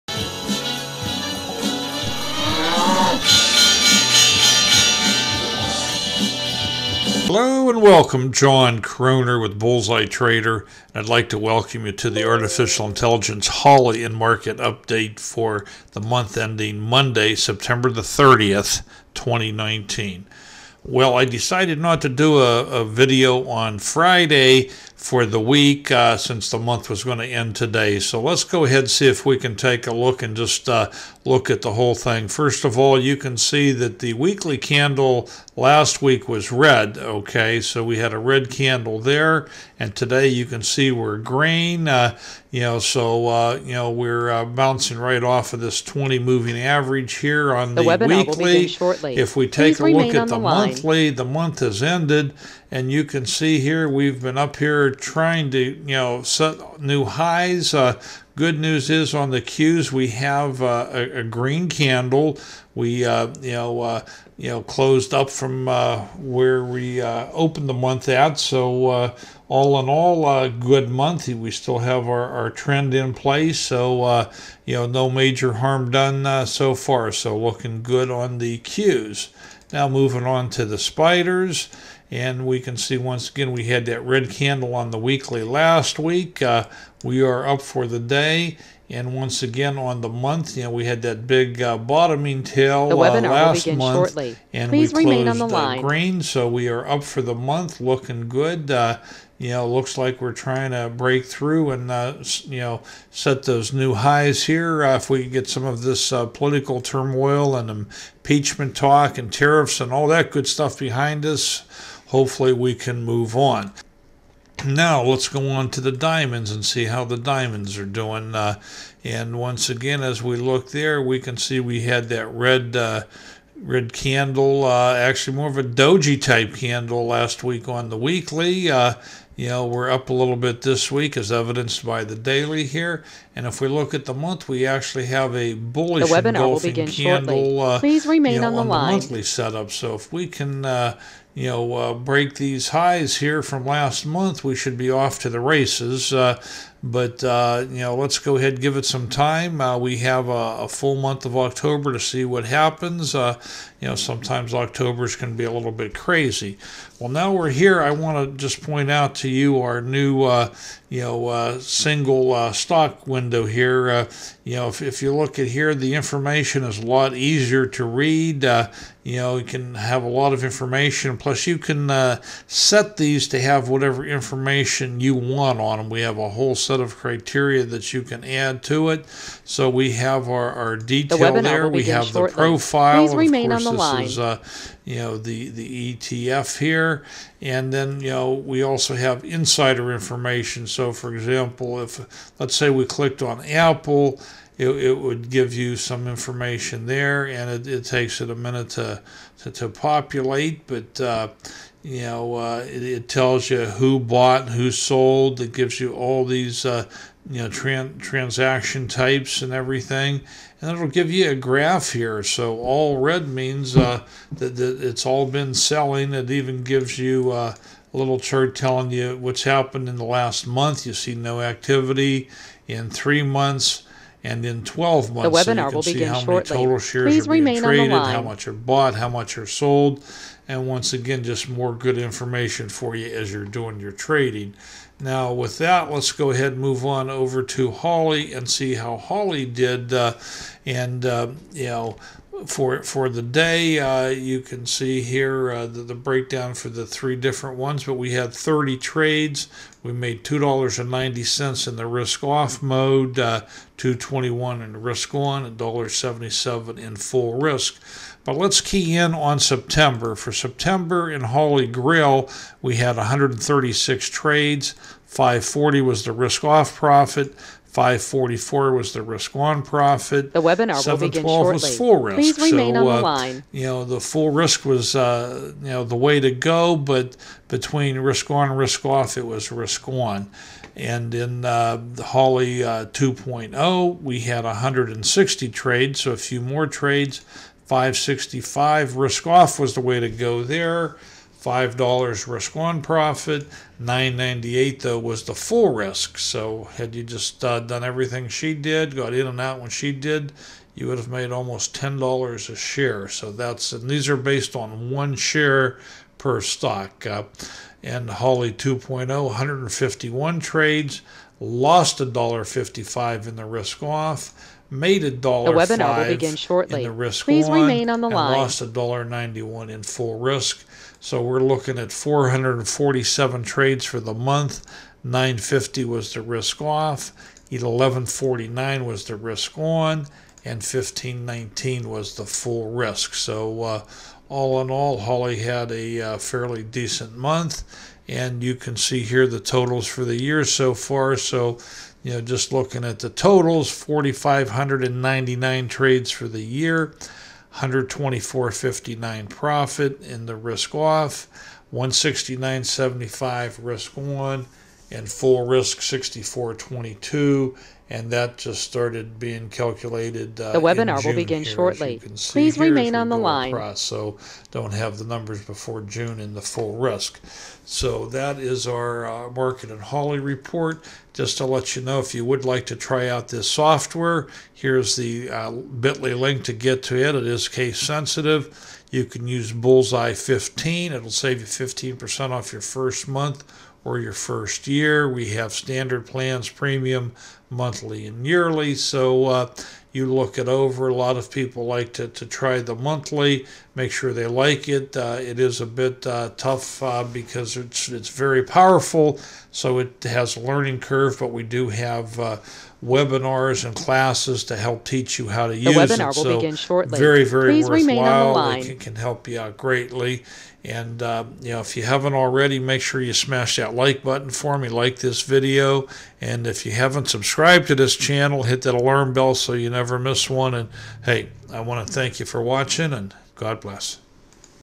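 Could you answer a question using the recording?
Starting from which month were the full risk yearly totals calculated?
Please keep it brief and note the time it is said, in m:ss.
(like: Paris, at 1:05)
June, at 6:05.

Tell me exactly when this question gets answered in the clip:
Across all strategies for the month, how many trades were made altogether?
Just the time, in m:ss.
5:21.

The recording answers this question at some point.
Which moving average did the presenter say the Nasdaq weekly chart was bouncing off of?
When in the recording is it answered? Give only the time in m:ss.
0:45.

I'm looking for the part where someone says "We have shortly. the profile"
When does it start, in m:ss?
3:01.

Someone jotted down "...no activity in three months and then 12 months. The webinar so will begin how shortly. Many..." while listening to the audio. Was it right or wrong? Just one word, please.
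right.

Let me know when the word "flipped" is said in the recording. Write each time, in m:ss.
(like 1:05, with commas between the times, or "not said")
not said.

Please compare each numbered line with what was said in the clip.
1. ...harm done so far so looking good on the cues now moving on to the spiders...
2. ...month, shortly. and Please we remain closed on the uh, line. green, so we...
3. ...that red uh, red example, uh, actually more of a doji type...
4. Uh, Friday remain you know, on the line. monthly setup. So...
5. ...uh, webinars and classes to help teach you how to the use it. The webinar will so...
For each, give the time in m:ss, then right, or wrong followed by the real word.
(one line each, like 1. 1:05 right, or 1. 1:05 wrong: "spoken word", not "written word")
1. 1:15 right
2. 1:33 right
3. 2:02 wrong: "candle", not "example"
4. 2:17 wrong: "Please", not "Friday"
5. 6:42 right.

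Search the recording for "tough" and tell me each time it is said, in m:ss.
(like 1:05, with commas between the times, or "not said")
6:36.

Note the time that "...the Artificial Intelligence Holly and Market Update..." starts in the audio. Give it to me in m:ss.
0:12.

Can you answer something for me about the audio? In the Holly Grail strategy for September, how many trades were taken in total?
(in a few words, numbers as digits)
136.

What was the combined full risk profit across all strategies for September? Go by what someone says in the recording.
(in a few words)
15.19.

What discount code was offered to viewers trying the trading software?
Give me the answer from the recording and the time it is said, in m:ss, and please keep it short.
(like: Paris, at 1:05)
Bullzeye 15, at 6:19.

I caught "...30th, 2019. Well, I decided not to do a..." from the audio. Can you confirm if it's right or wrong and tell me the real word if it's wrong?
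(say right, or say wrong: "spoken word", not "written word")
right.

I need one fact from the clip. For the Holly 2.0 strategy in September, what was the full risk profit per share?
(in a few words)
9.98.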